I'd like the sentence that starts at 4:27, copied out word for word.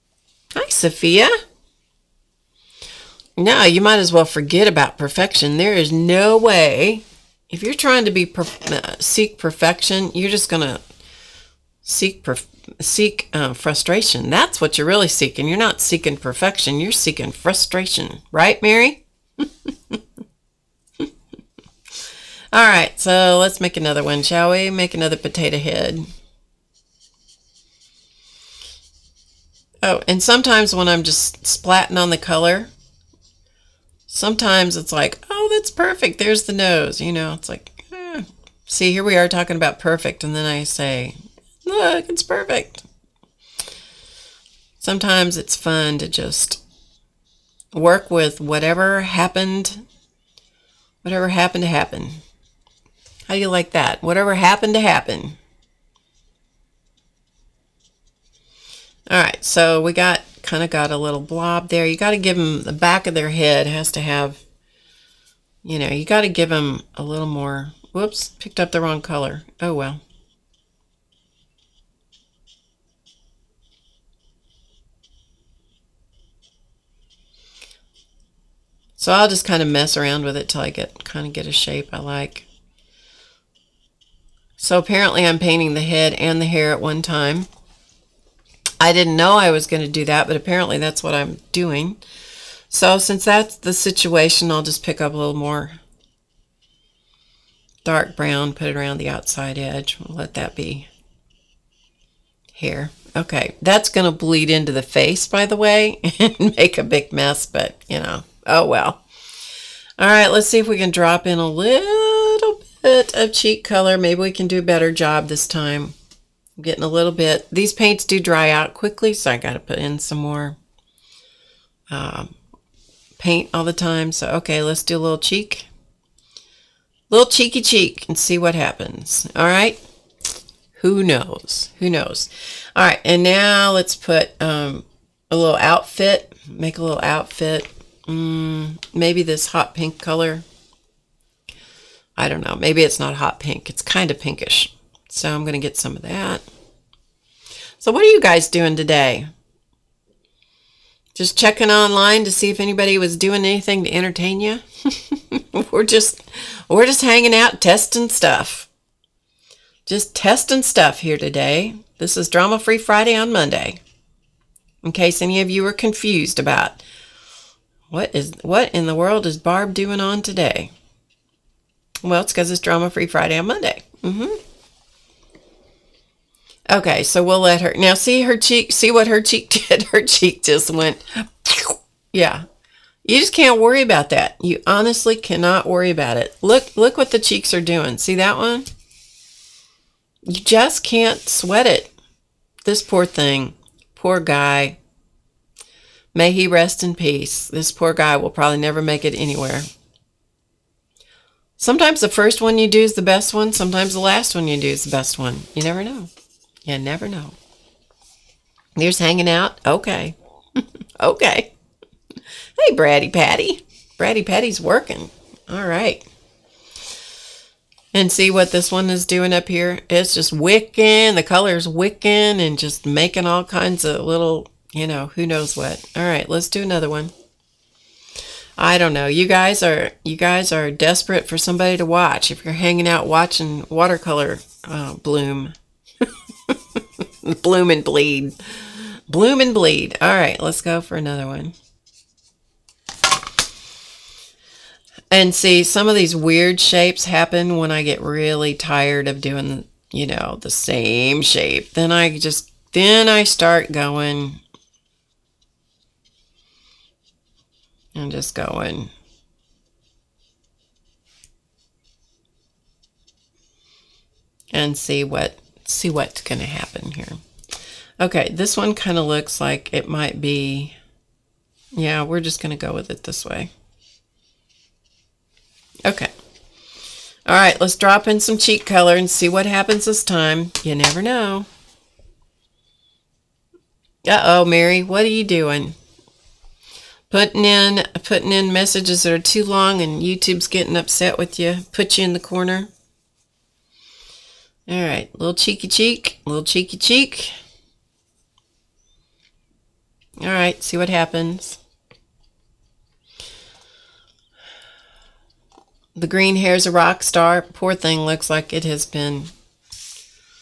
Okay, this one kind of looks like it might be, yeah, we're just going to go with it this way.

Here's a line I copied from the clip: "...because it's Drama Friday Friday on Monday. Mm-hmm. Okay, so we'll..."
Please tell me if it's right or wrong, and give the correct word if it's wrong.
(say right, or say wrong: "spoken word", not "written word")
wrong: "Free", not "Friday".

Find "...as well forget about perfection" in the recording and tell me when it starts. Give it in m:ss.
0:03.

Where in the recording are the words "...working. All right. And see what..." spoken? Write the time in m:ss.
3:34.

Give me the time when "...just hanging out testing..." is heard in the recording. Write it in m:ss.
2:36.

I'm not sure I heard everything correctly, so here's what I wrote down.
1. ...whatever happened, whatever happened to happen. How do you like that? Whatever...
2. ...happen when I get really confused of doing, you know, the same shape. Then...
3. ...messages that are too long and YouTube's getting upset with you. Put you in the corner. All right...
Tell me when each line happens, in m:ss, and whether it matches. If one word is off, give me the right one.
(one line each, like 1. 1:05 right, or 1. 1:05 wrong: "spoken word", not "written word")
1. 0:48 right
2. 4:07 wrong: "tired", not "confused"
3. 4:48 right.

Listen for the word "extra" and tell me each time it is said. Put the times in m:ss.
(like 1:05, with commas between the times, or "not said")
not said.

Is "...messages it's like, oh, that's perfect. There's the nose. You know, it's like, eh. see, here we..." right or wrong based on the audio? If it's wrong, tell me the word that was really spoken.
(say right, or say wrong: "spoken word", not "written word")
wrong: "sometimes", not "messages".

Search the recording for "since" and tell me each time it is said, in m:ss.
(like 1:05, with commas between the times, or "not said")
1:32.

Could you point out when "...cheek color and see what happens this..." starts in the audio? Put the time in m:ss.
4:38.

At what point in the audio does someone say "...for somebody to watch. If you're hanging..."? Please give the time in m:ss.
3:51.